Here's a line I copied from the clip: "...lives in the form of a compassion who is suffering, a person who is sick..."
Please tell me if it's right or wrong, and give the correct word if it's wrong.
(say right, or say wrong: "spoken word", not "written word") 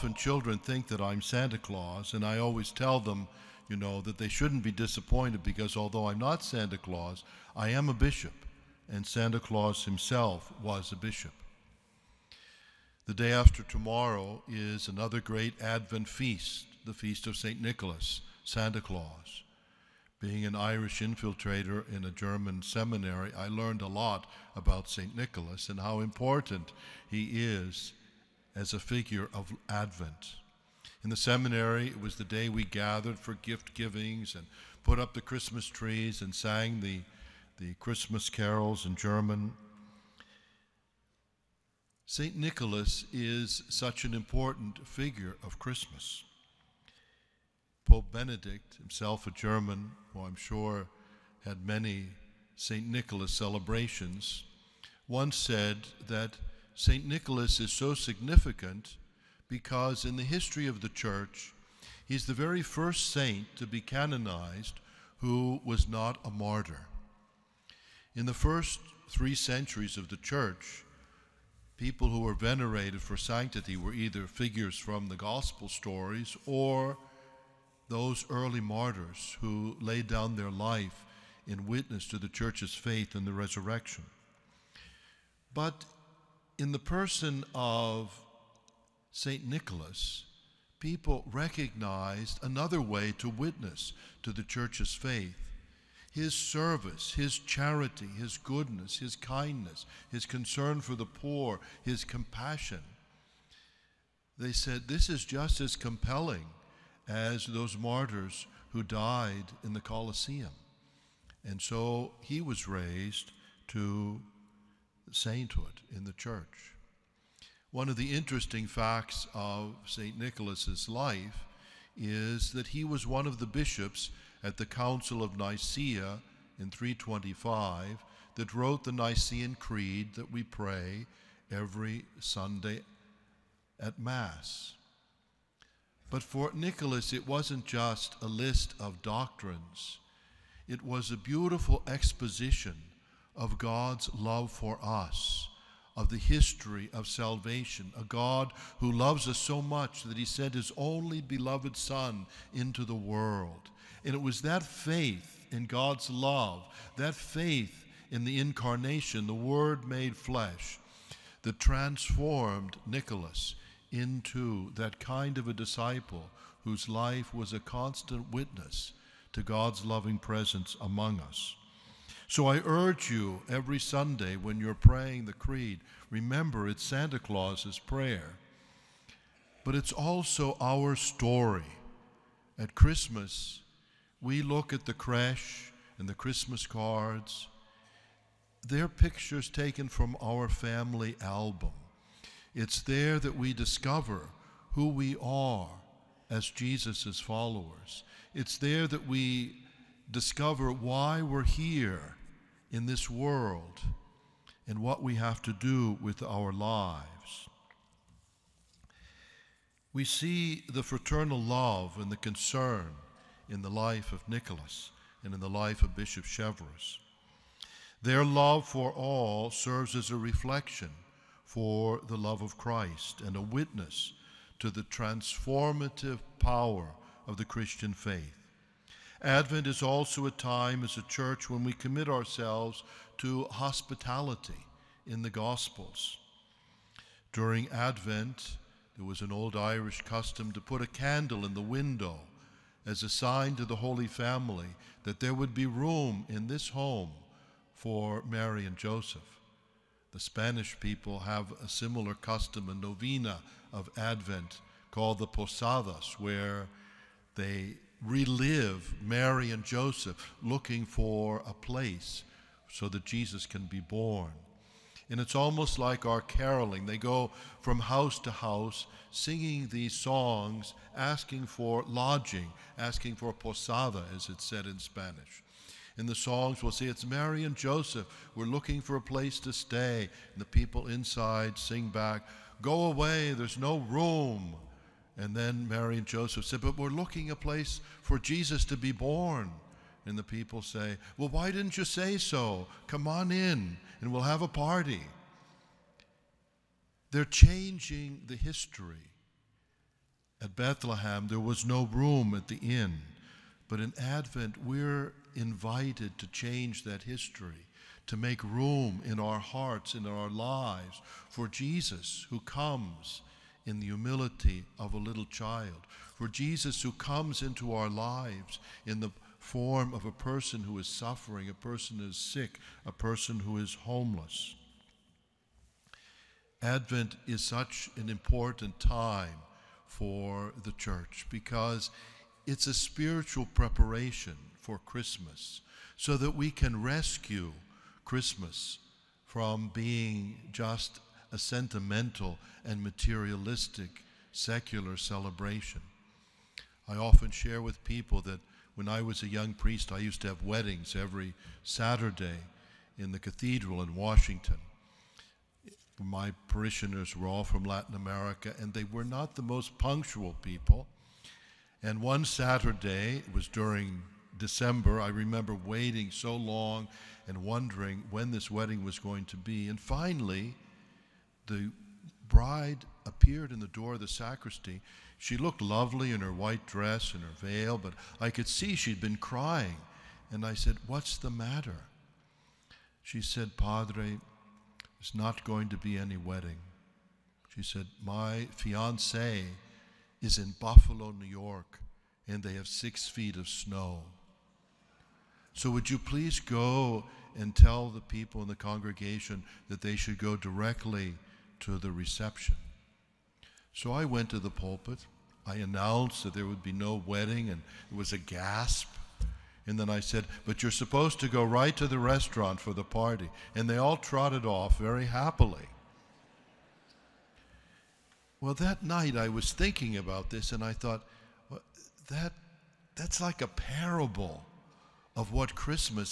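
wrong: "person", not "compassion".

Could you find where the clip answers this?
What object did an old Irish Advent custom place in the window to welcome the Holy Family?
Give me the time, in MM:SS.
04:00.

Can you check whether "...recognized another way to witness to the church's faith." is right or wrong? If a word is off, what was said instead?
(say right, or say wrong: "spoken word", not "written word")
right.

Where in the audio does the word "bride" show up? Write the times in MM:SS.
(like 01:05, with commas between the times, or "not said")
06:12.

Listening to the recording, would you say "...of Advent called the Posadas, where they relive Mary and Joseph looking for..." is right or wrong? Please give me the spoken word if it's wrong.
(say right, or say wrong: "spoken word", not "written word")
right.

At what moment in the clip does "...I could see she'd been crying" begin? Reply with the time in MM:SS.
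06:18.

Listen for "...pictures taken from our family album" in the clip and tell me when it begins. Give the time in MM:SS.
03:08.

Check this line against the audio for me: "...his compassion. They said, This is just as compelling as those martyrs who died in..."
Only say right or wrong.
right.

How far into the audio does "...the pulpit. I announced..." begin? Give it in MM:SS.
06:44.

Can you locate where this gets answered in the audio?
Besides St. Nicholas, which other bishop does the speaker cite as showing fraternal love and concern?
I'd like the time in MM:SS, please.
03:35.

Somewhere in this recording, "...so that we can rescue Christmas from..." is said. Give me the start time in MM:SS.
05:35.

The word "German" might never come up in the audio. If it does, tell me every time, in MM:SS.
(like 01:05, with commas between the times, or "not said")
00:22, 00:38, 00:49.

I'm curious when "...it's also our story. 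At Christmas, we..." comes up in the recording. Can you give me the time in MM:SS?
02:59.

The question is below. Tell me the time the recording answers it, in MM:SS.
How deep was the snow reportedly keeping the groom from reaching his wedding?
06:32.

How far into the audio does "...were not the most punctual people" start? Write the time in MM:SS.
05:58.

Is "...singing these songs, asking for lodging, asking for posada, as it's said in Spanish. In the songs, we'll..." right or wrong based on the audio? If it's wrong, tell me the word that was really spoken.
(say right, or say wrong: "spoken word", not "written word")
right.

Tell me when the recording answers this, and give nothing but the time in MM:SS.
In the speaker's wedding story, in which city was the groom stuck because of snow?
06:30.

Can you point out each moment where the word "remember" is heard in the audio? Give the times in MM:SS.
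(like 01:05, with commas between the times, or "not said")
02:56, 06:05.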